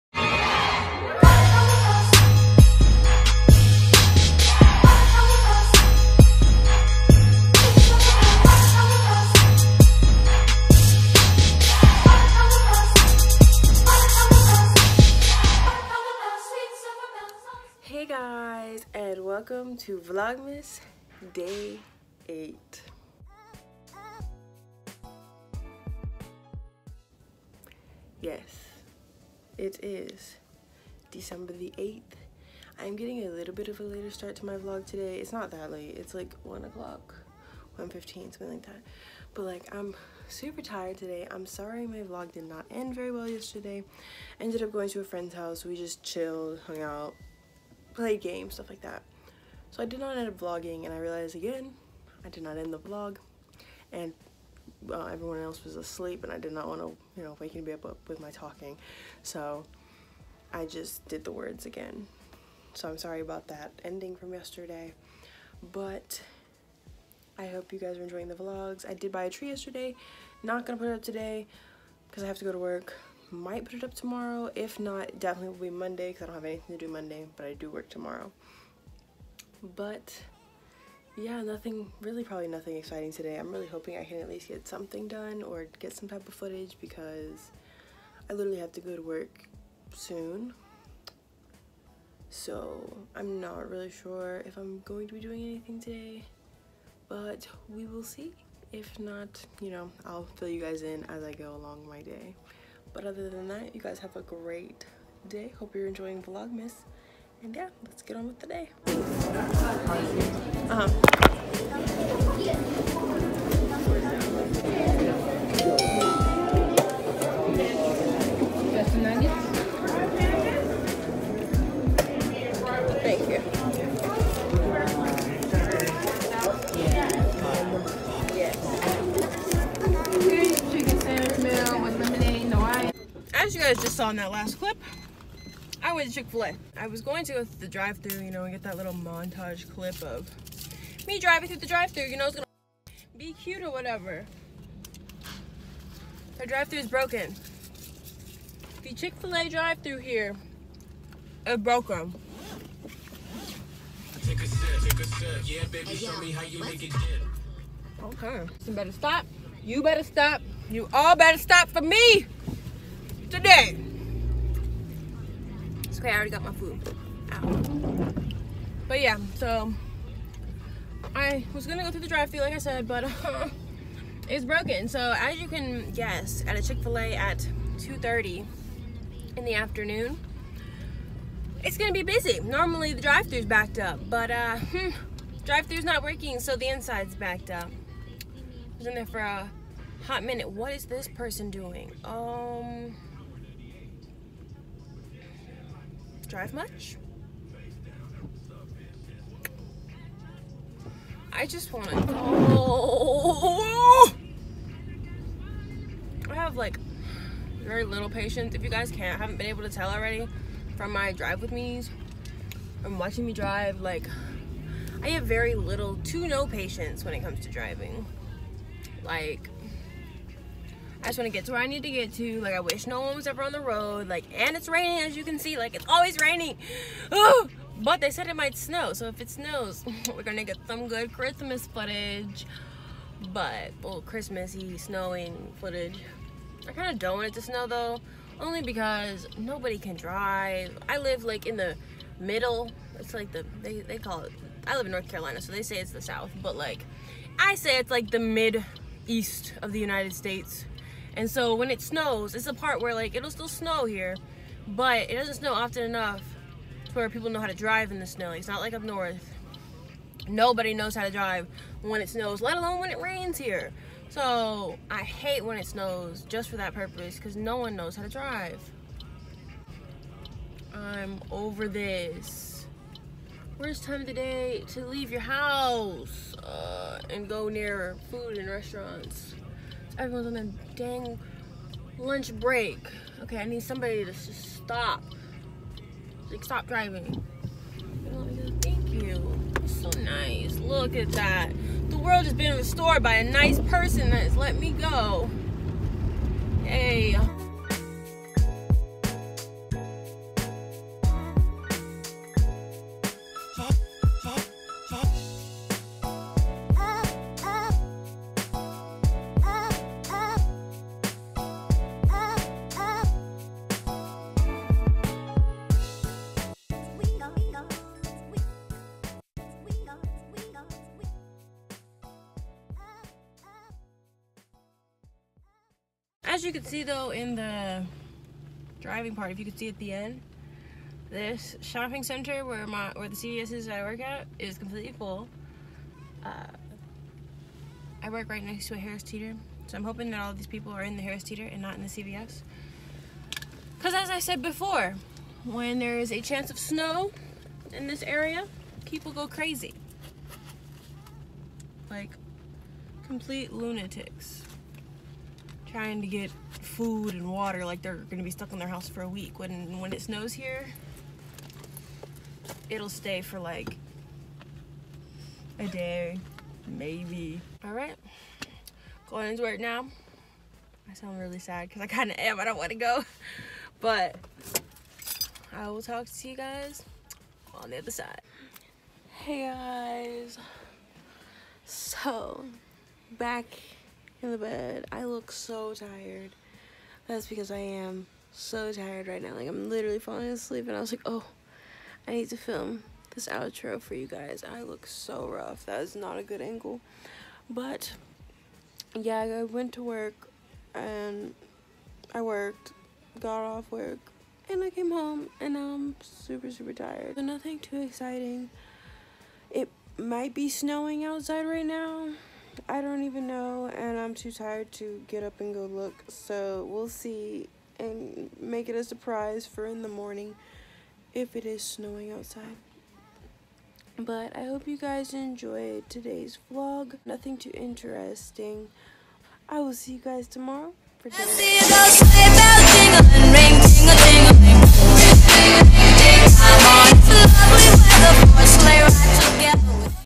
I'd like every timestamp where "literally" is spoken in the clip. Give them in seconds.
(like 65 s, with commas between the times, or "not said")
88 s, 389 s.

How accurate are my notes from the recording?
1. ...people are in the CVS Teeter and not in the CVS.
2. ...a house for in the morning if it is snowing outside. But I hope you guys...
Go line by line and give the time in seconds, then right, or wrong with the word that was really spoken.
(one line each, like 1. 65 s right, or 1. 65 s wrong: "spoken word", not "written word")
1. 340 s wrong: "Harris", not "CVS"
2. 418 s wrong: "surprise", not "house".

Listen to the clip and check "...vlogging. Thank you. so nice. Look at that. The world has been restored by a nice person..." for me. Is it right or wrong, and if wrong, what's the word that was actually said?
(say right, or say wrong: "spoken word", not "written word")
wrong: "driving", not "vlogging".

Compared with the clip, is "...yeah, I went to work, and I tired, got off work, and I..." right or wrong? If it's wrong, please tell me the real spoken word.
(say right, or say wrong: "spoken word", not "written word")
wrong: "worked", not "tired".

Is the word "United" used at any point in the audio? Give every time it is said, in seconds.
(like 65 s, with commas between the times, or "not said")
249 s.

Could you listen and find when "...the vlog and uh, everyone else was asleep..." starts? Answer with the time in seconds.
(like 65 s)
52 s.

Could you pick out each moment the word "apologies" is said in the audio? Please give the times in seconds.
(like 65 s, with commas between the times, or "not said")
not said.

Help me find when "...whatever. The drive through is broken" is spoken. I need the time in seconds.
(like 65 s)
143 s.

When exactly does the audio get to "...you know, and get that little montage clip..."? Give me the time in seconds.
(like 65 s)
138 s.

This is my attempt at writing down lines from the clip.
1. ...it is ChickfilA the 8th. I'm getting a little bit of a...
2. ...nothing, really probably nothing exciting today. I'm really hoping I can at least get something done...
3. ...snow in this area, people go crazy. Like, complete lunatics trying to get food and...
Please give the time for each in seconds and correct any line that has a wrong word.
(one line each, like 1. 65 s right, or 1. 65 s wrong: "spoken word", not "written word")
1. 29 s wrong: "December", not "ChickfilA"
2. 81 s right
3. 346 s right.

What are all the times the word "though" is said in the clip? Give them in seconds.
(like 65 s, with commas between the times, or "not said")
237 s, 326 s.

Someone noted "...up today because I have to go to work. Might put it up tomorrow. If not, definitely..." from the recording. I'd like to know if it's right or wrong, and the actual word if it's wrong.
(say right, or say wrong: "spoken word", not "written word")
right.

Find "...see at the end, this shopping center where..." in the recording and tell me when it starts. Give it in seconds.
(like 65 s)
329 s.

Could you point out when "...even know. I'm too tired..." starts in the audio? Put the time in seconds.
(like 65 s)
413 s.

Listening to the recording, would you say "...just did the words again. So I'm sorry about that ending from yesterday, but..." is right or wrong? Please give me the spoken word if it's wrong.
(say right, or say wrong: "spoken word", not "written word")
right.